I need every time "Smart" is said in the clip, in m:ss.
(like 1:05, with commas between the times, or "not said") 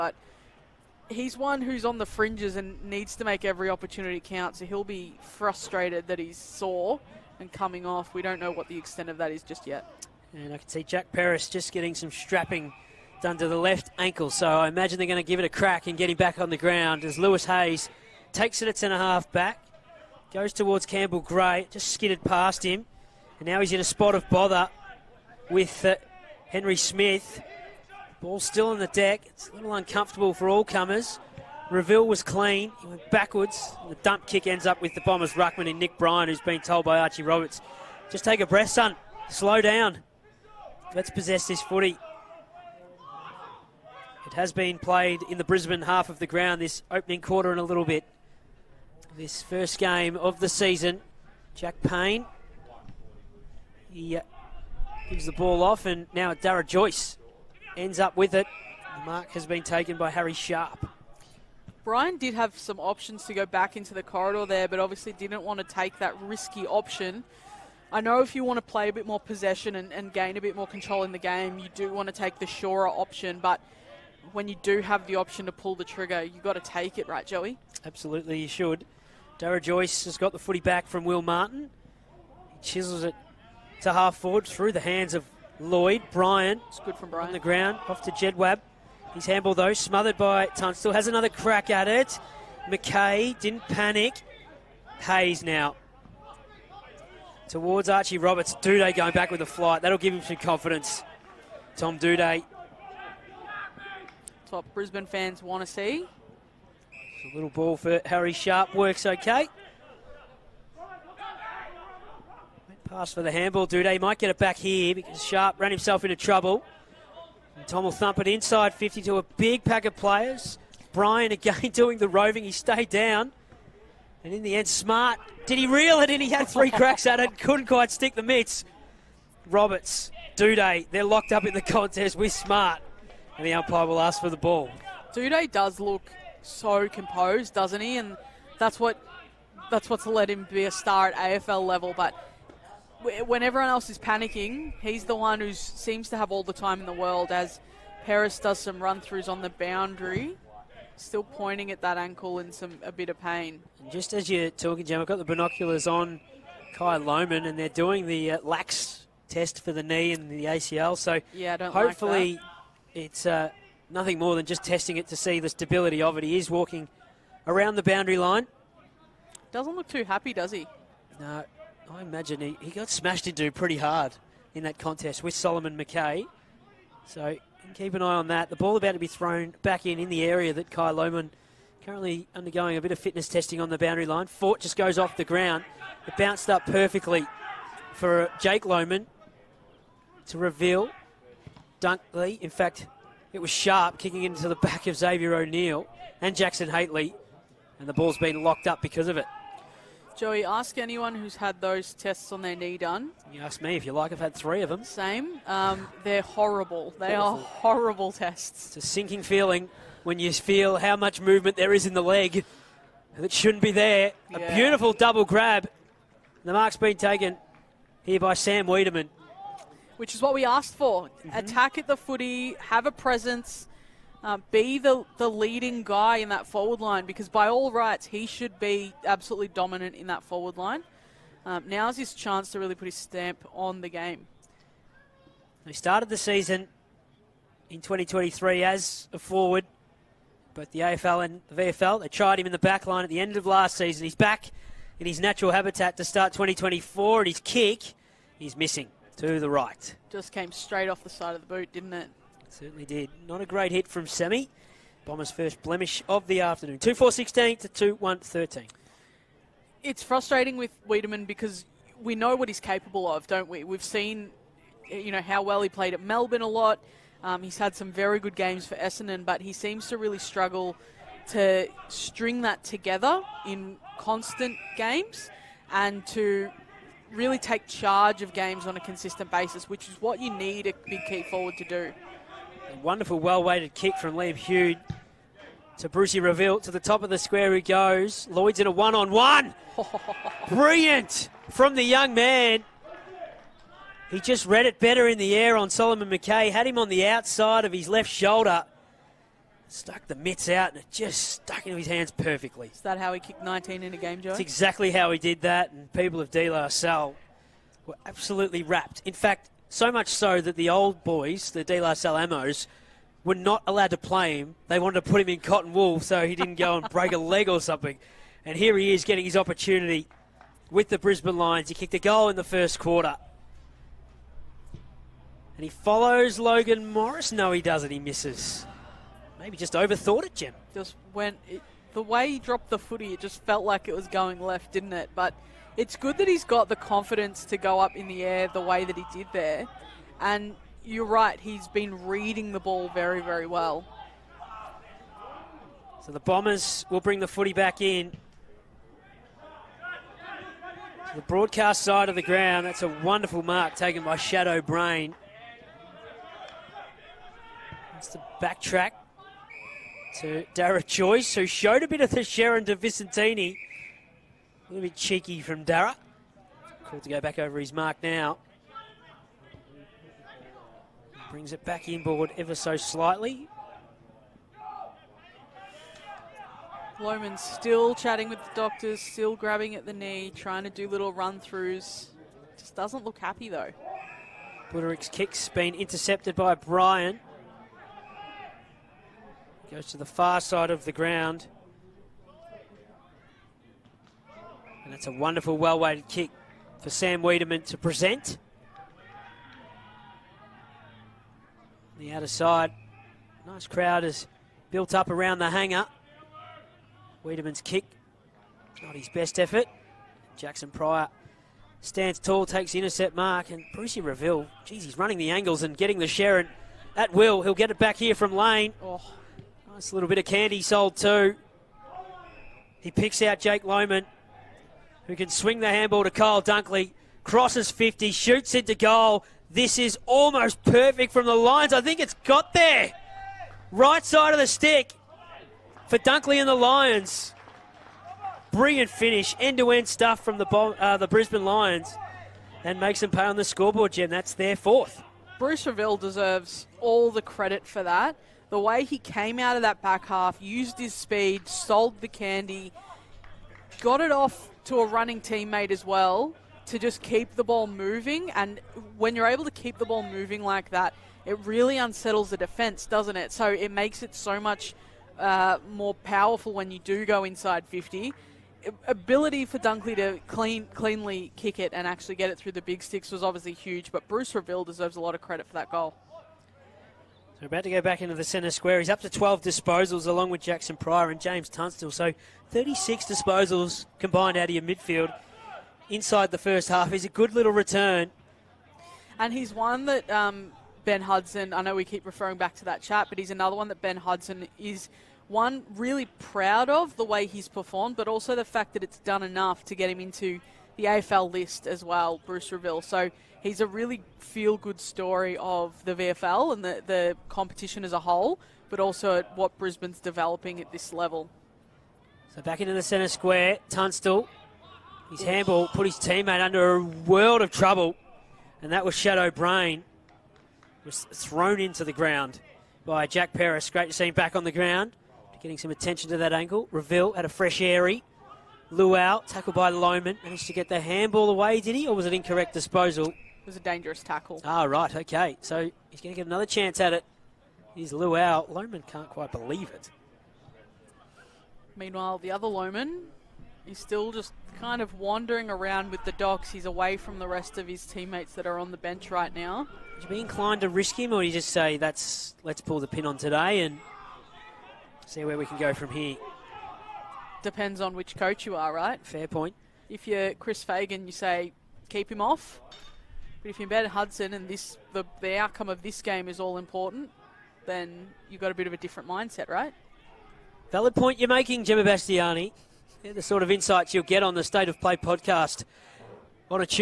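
2:04, 2:12.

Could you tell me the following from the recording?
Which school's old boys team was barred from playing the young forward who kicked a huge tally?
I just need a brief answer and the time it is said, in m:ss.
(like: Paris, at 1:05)
De La Salle, at 5:06.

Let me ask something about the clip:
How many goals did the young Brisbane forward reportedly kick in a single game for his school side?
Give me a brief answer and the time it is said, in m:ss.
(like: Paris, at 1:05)
19, at 5:03.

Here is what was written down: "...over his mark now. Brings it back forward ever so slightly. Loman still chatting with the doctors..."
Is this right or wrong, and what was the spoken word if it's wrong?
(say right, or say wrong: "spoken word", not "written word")
wrong: "inboard", not "forward".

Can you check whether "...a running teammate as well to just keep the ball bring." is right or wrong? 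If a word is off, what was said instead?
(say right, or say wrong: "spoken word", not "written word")
wrong: "moving", not "bring".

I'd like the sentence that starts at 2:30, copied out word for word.
Still pointing at that ankle in some a bit of pain.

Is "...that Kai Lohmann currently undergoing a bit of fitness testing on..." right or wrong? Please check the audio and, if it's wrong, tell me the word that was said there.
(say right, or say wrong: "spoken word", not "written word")
right.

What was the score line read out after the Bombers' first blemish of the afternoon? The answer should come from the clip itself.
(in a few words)
2 4 16 to 2 1 13.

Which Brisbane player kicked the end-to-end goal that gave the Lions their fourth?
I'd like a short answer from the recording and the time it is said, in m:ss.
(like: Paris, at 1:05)
Kyle Dunkley, at 7:06.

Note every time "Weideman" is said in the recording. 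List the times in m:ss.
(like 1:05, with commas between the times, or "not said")
3:38, 4:20, 6:37, 6:47.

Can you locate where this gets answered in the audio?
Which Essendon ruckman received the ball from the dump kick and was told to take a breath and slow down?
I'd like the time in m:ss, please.
0:35.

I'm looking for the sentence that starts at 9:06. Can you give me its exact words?
He's away from the rest of his teammates that are on the bench right now.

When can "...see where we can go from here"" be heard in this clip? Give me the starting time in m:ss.
9:15.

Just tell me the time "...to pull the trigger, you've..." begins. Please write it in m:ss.
1:15.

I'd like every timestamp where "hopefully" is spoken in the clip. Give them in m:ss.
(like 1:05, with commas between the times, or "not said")
2:41.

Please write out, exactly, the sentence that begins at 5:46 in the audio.
So the Bombers will bring the footy back in.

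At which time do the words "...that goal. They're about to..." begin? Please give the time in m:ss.
7:55.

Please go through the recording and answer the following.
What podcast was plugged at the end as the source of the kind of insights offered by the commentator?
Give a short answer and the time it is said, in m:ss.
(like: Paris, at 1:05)
State of Play, at 9:34.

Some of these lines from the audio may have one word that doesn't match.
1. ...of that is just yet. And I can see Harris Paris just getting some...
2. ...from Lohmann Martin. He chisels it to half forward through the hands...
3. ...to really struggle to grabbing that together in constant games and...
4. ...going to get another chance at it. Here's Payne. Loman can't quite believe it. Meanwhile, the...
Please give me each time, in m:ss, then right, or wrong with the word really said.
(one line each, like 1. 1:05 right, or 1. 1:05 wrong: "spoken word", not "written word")
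1. 0:09 wrong: "Jack", not "Harris"
2. 1:20 wrong: "Will", not "Lohmann"
3. 4:29 wrong: "string", not "grabbing"
4. 8:56 wrong: "Luau", not "Payne".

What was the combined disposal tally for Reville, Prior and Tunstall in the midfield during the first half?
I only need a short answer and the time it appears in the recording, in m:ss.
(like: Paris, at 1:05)
36, at 8:02.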